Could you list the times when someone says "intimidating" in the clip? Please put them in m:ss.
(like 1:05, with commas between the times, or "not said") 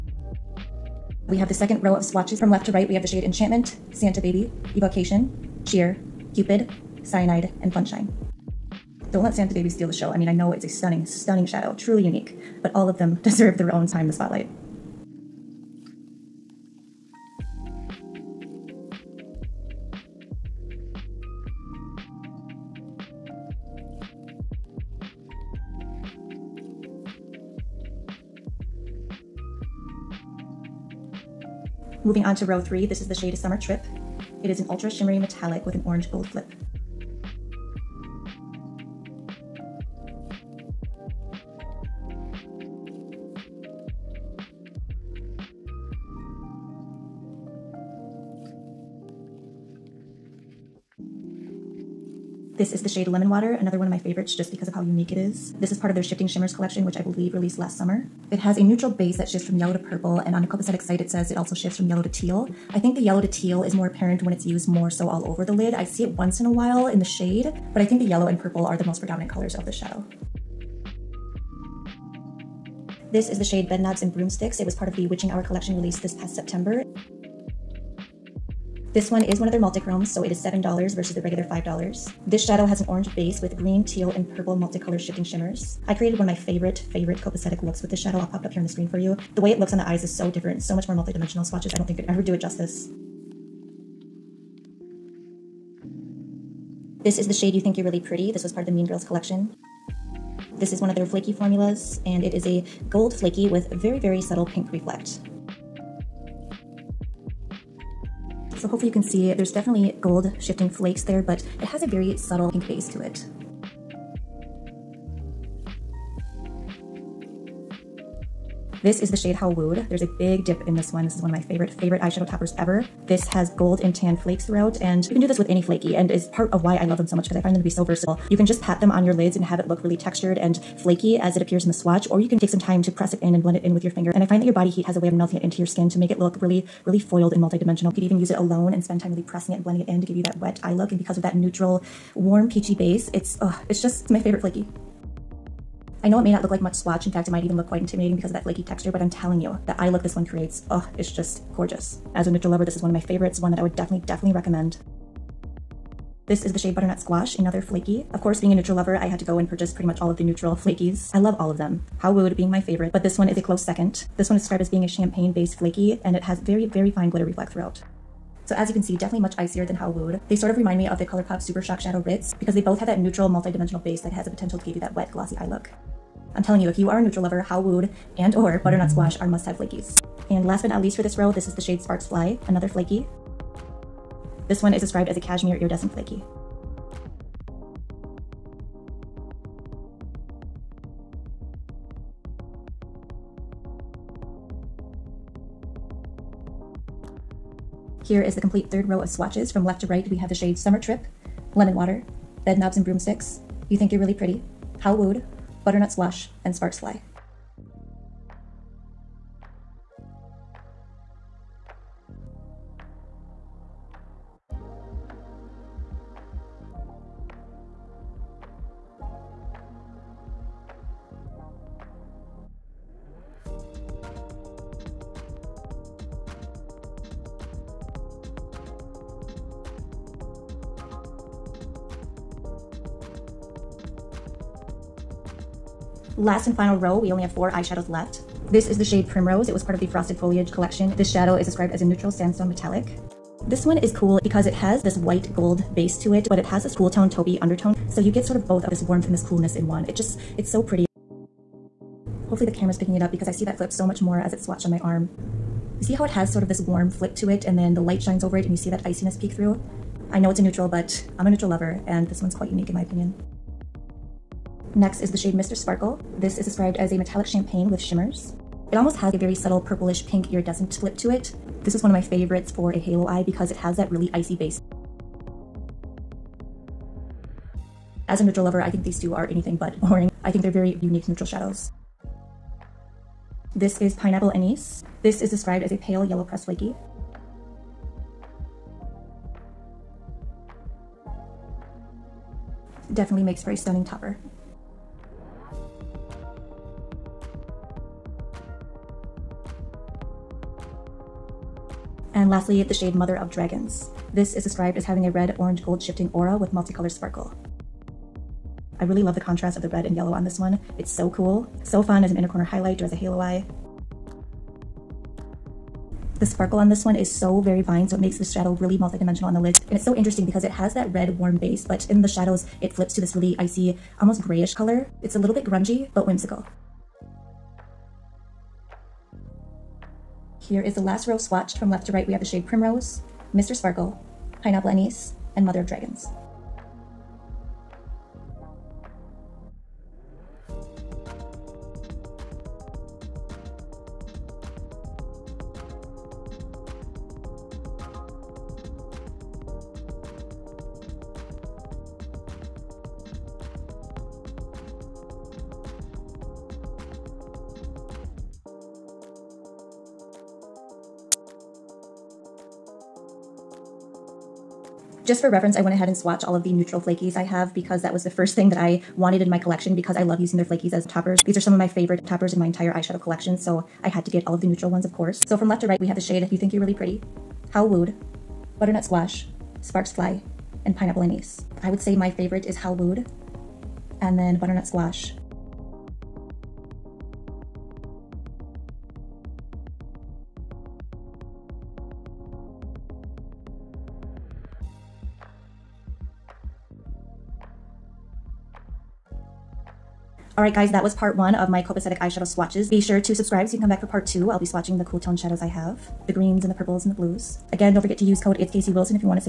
2:27.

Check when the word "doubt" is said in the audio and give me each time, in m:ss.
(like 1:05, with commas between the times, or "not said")
not said.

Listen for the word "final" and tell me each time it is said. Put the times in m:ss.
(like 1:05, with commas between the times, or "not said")
3:56.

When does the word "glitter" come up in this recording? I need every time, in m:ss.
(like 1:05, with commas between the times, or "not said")
2:47.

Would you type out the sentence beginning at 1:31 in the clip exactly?
I don't think could ever do it justice.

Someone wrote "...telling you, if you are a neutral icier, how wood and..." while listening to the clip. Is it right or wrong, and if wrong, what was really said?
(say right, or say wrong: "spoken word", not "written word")
wrong: "lover", not "icier".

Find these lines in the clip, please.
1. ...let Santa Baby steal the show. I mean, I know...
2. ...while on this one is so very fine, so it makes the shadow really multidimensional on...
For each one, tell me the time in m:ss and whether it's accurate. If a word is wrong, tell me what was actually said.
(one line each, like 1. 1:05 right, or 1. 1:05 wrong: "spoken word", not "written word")
1. 0:09 right
2. 5:16 wrong: "sparkle", not "while".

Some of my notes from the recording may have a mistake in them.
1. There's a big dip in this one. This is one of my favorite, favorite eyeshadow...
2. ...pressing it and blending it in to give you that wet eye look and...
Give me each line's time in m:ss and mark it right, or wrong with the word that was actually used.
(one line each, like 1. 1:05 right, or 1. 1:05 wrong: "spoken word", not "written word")
1. 1:59 right
2. 2:19 right.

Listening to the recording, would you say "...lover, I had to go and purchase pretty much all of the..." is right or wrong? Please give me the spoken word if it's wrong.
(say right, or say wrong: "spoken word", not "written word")
right.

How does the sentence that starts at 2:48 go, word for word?
So as you can see, definitely much icier than Howwood.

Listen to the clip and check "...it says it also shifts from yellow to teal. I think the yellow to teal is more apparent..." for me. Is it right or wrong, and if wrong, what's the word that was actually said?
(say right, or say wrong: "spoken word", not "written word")
right.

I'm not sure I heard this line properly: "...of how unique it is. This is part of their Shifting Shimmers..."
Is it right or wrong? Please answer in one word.
right.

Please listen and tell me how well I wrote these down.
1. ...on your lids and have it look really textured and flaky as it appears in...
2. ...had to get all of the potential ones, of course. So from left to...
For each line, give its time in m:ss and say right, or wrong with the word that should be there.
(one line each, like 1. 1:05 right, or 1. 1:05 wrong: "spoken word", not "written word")
1. 2:08 right
2. 6:13 wrong: "neutral", not "potential".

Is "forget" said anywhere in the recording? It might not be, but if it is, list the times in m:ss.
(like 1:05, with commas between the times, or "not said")
6:47.